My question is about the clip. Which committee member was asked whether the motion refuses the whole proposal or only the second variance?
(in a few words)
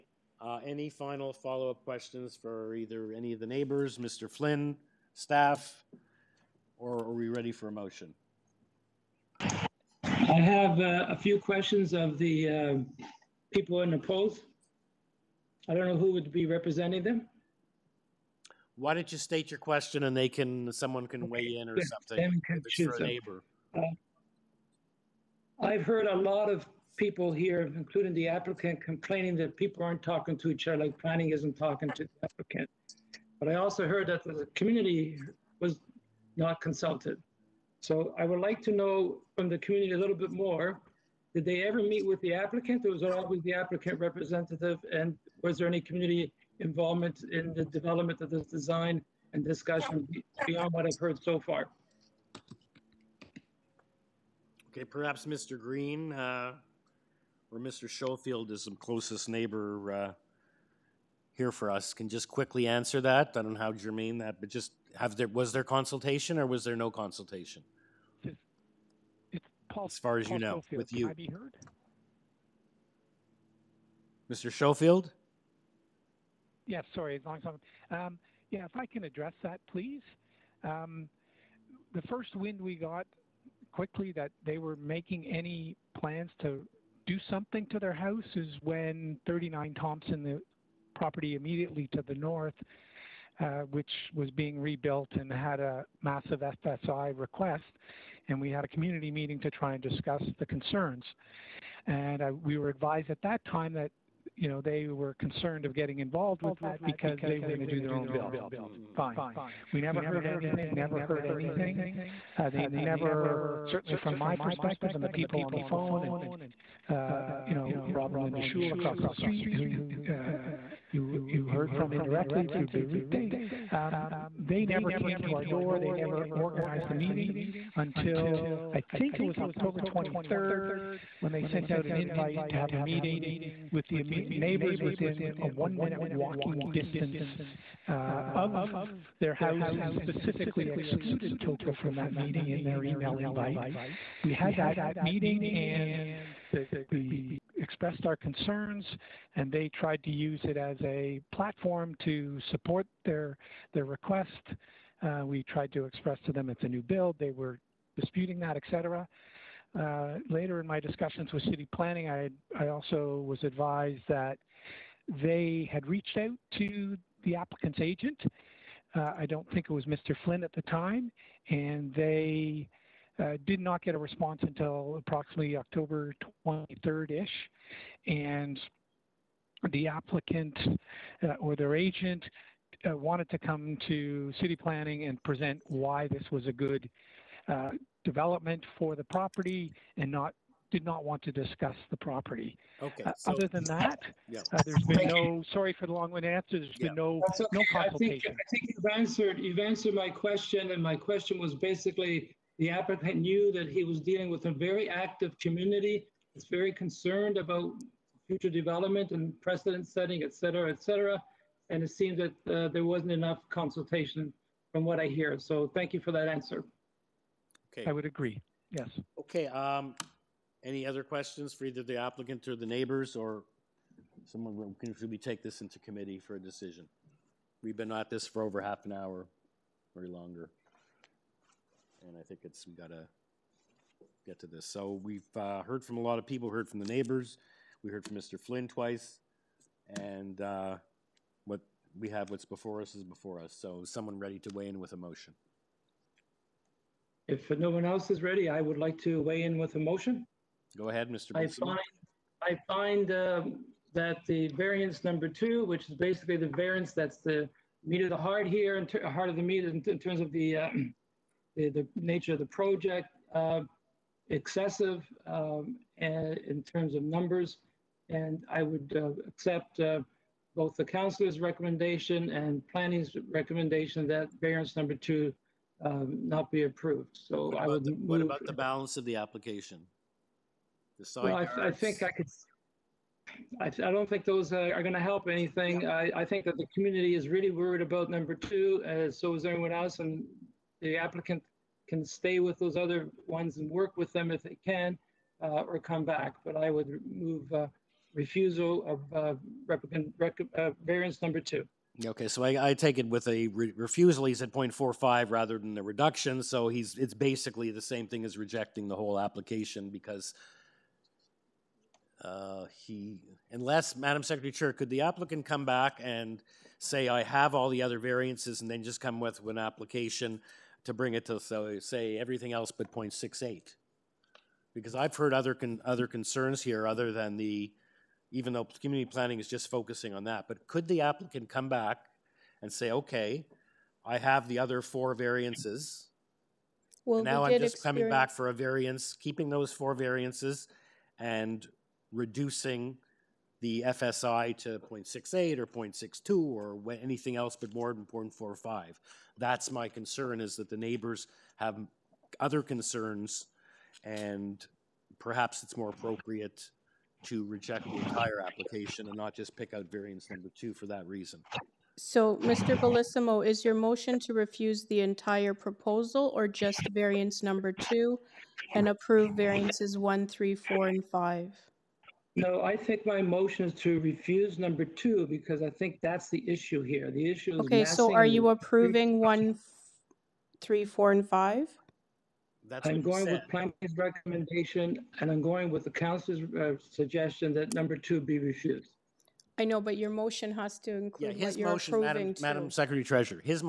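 Mr. Bellissimo.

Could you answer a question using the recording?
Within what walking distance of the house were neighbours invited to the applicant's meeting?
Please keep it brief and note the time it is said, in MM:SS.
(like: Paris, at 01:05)
one minute, at 02:15.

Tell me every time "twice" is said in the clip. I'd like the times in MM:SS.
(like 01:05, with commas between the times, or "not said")
03:58.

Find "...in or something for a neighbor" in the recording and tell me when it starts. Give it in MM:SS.
00:21.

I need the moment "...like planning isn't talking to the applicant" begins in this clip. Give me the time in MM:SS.
00:30.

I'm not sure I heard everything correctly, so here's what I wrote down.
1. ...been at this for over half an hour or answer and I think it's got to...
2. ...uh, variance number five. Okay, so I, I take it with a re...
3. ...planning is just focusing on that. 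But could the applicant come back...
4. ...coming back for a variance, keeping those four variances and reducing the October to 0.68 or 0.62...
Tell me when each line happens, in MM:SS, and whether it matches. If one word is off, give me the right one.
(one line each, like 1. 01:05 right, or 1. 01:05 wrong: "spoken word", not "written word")
1. 03:47 wrong: "longer", not "answer"
2. 05:00 wrong: "two", not "five"
3. 05:29 right
4. 05:37 wrong: "FSI", not "October".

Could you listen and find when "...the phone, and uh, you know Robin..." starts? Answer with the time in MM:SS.
01:55.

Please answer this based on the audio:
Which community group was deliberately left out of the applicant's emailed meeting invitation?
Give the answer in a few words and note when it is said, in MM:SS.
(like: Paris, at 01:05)
TOCA, at 02:21.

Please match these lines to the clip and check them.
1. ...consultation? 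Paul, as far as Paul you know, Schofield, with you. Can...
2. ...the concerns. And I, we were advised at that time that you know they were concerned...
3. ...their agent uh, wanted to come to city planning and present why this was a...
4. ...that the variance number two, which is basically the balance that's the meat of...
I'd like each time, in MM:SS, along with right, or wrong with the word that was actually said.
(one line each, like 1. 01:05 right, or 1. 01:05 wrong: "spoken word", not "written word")
1. 01:06 right
2. 01:40 right
3. 03:01 right
4. 04:13 wrong: "variance", not "balance".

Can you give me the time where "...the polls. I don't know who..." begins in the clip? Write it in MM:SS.
00:13.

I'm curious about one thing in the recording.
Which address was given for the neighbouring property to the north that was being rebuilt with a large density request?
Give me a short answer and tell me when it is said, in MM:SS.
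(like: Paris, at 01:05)
39 Thompson, at 01:29.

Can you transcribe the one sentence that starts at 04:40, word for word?
The side well, I, I, think I could.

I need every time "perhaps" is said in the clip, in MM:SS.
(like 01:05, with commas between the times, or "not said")
00:54, 05:55.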